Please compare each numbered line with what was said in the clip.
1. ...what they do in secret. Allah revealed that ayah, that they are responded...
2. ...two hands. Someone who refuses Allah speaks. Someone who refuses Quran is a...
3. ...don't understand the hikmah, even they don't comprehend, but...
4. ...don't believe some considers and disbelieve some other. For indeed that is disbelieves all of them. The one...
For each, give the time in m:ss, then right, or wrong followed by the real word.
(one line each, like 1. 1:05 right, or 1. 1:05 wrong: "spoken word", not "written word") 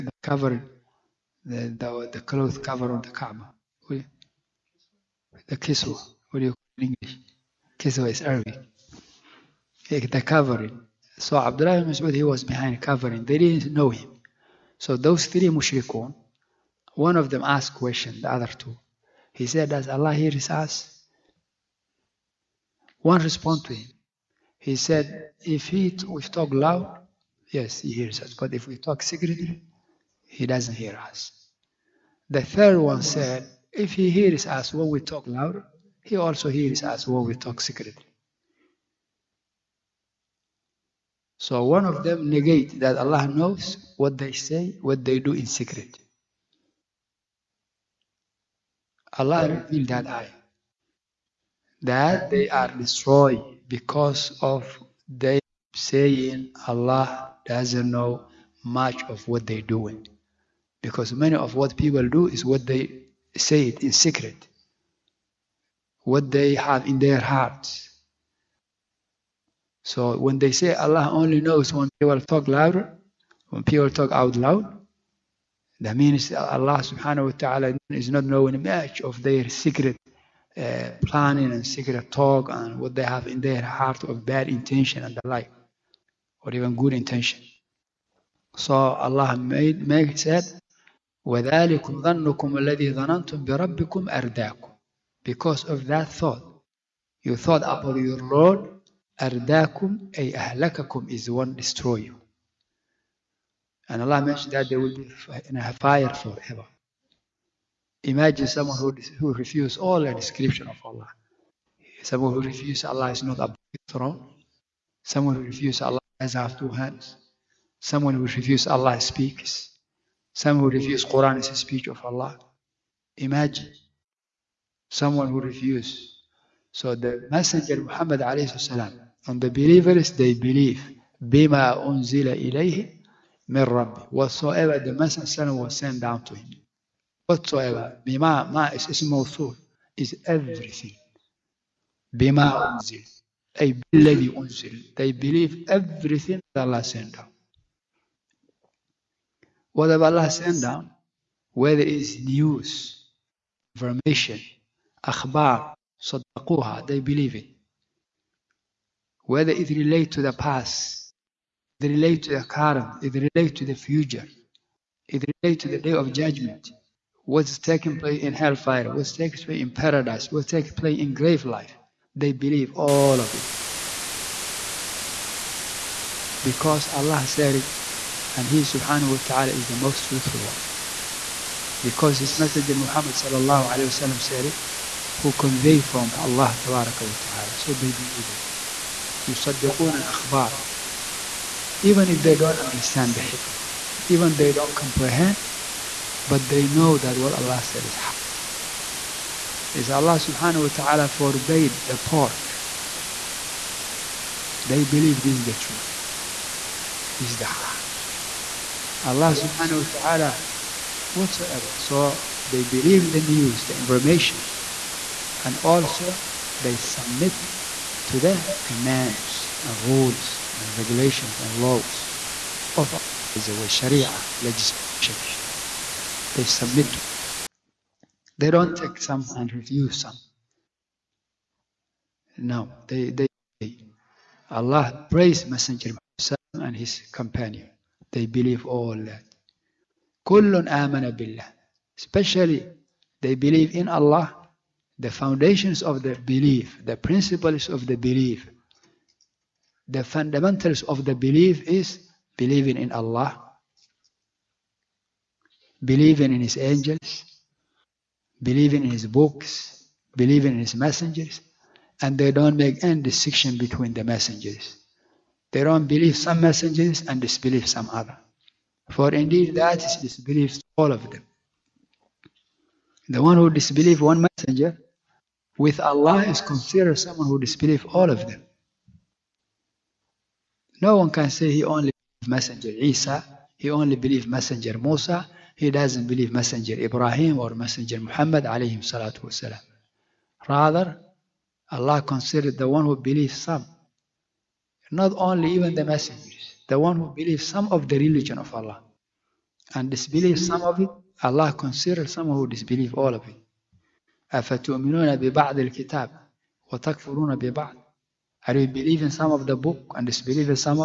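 1. 0:44 wrong: "destroyed", not "responded"
2. 1:56 right
3. 3:12 right
4. 4:25 wrong: "messengers", not "considers".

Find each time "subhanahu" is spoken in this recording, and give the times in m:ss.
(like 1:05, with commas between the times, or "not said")
1:16, 2:58, 3:20, 3:29.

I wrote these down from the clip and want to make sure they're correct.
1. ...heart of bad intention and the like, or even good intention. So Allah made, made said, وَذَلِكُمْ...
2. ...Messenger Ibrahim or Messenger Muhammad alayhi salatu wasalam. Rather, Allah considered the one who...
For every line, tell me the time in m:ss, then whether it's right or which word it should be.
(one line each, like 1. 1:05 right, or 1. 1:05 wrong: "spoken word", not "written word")
1. 1:23 right
2. 4:46 right.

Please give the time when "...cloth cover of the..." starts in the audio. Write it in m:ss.
0:02.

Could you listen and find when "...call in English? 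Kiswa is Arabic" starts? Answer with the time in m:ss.
0:06.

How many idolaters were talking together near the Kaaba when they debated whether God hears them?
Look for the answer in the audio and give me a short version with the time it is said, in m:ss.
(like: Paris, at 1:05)
3, at 0:15.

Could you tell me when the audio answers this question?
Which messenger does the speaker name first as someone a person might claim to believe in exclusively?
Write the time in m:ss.
4:42.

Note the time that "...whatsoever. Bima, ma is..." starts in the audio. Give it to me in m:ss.
2:17.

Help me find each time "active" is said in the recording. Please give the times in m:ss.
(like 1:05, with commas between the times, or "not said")
not said.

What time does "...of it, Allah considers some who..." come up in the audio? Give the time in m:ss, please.
5:00.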